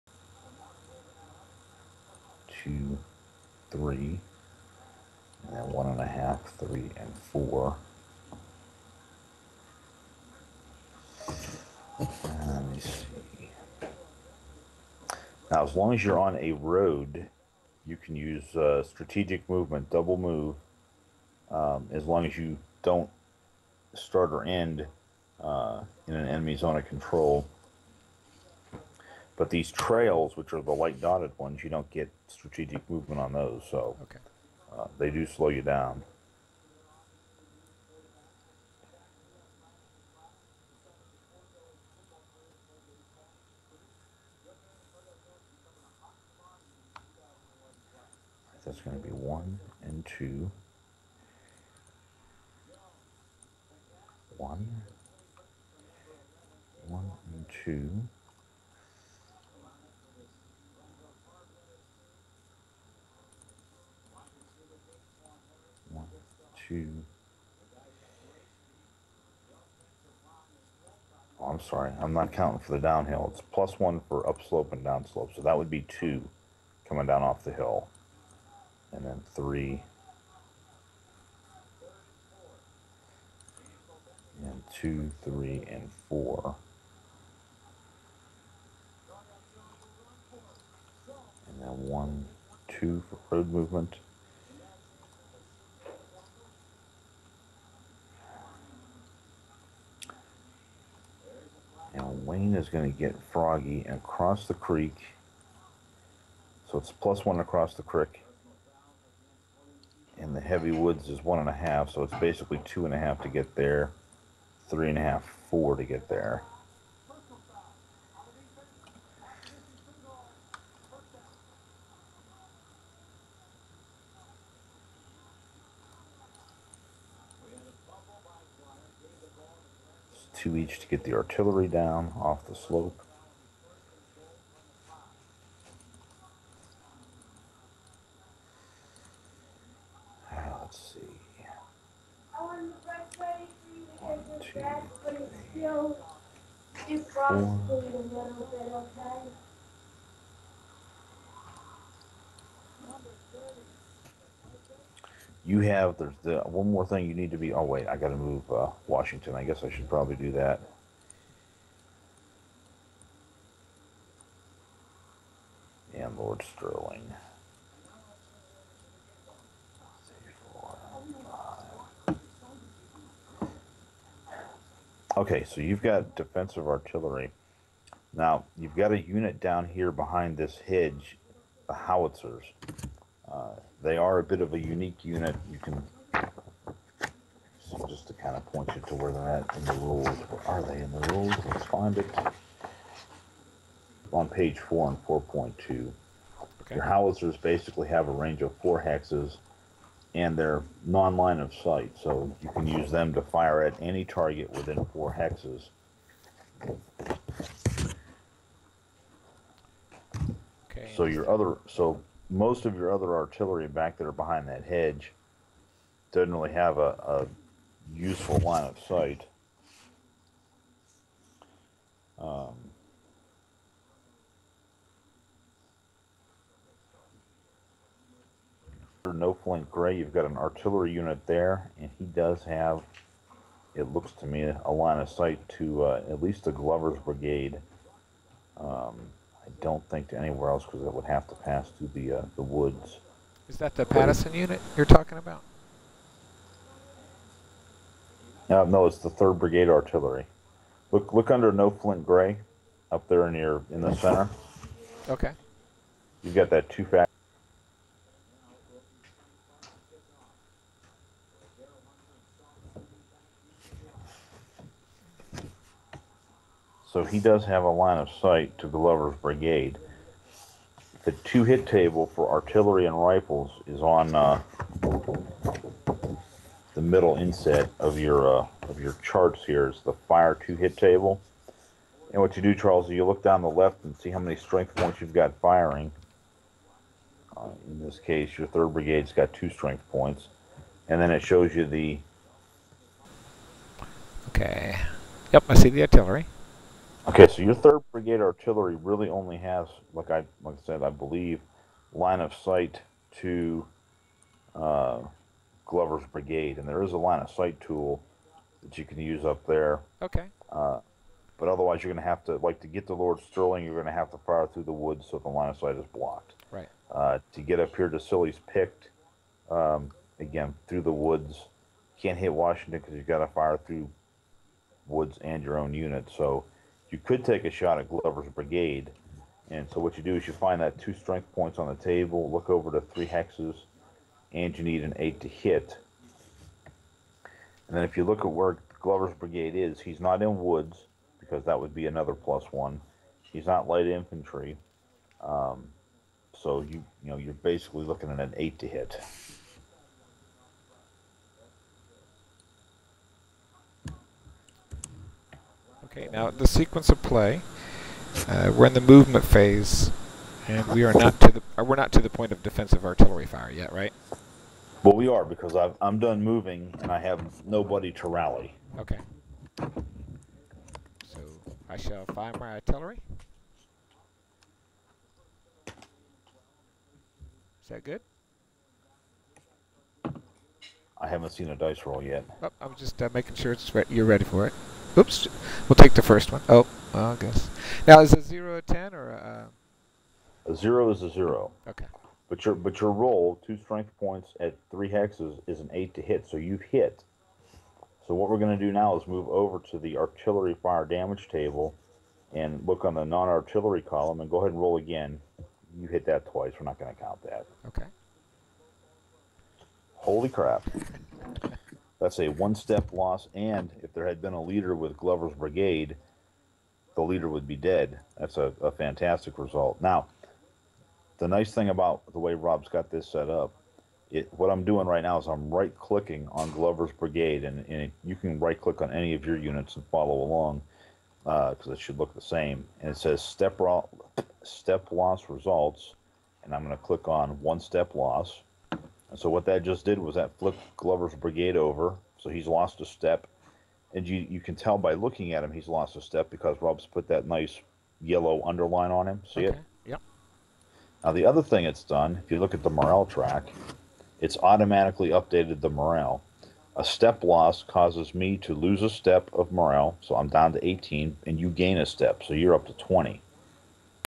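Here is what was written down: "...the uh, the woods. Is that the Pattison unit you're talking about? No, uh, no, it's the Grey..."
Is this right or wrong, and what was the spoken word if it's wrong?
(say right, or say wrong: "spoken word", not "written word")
wrong: "Third", not "Grey".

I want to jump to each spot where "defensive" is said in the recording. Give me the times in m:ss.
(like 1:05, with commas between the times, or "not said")
2:56, 6:02.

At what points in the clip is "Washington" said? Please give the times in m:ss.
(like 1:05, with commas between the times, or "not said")
2:38, 5:22.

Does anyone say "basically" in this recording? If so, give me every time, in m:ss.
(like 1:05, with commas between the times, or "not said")
1:52, 3:17, 5:47.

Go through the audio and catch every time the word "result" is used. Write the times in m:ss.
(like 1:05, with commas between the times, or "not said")
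6:59, 7:15.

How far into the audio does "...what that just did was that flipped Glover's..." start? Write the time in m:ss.
7:19.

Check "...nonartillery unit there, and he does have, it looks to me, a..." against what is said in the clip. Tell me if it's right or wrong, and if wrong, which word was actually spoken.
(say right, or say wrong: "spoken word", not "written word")
wrong: "artillery", not "nonartillery".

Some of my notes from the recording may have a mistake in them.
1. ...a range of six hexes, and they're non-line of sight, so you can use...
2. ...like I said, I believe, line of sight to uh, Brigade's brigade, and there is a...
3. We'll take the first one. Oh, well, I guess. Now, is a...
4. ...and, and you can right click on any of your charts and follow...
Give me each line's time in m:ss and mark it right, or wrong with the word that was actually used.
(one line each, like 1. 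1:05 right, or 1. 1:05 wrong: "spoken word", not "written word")
1. 3:18 wrong: "four", not "six"
2. 5:00 wrong: "Glover", not "Brigade"
3. 6:25 right
4. 7:07 wrong: "units", not "charts".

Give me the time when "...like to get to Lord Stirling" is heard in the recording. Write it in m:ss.
5:12.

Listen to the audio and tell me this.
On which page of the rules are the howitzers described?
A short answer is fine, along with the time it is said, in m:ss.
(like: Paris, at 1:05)
page 4, at 3:14.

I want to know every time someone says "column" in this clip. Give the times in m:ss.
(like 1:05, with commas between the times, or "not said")
6:43.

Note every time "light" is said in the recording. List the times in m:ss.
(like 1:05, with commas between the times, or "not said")
0:30, 5:43.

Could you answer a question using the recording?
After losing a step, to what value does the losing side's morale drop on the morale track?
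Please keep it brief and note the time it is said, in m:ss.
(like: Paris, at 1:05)
18, at 7:40.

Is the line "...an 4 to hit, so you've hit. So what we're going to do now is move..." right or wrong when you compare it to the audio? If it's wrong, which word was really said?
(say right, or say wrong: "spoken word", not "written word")
wrong: "8", not "4".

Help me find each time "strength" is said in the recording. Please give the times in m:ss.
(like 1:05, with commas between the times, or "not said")
4:44, 4:49, 5:30, 6:33.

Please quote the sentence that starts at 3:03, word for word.
Uh, they are a bit of a unique unit.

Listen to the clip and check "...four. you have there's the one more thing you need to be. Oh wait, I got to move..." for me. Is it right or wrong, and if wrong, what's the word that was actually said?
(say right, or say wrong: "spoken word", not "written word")
right.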